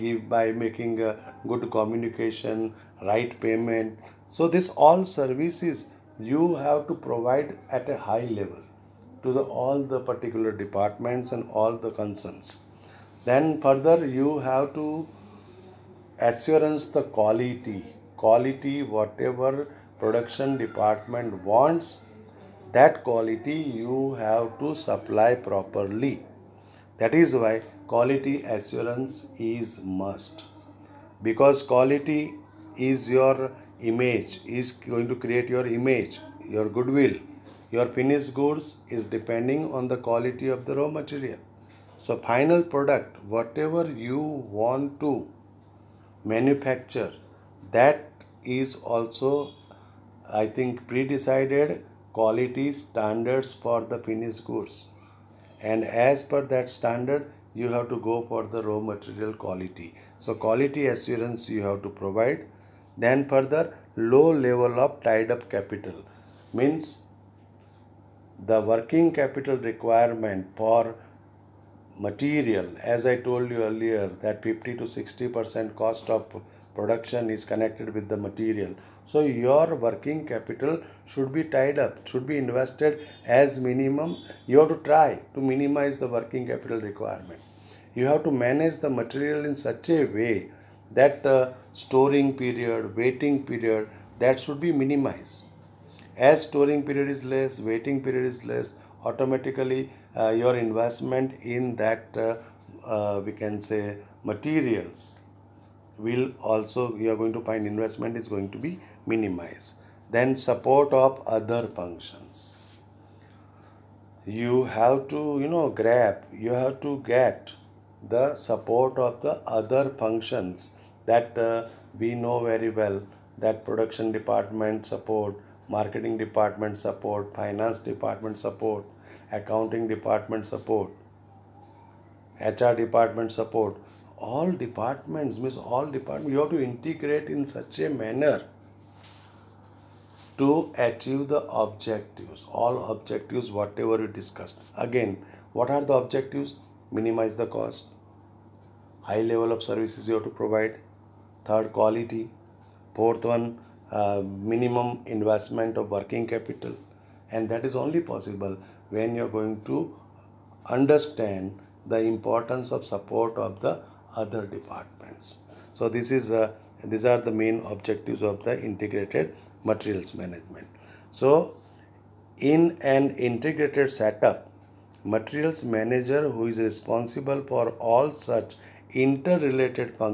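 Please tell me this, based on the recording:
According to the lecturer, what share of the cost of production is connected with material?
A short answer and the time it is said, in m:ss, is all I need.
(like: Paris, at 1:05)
50 to 60 percent, at 1:14.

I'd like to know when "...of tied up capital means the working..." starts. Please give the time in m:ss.
1:04.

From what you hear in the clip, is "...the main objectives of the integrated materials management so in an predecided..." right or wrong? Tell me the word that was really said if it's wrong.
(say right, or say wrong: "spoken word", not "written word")
wrong: "integrated", not "predecided".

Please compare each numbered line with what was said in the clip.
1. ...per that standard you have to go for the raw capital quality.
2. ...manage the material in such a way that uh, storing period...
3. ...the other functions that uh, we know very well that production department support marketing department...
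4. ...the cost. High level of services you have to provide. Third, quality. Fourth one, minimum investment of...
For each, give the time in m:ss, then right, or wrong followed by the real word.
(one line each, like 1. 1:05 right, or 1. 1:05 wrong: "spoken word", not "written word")
1. 0:56 wrong: "material", not "capital"
2. 1:28 right
3. 1:59 right
4. 2:27 right.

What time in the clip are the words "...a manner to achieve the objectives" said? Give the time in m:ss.
2:17.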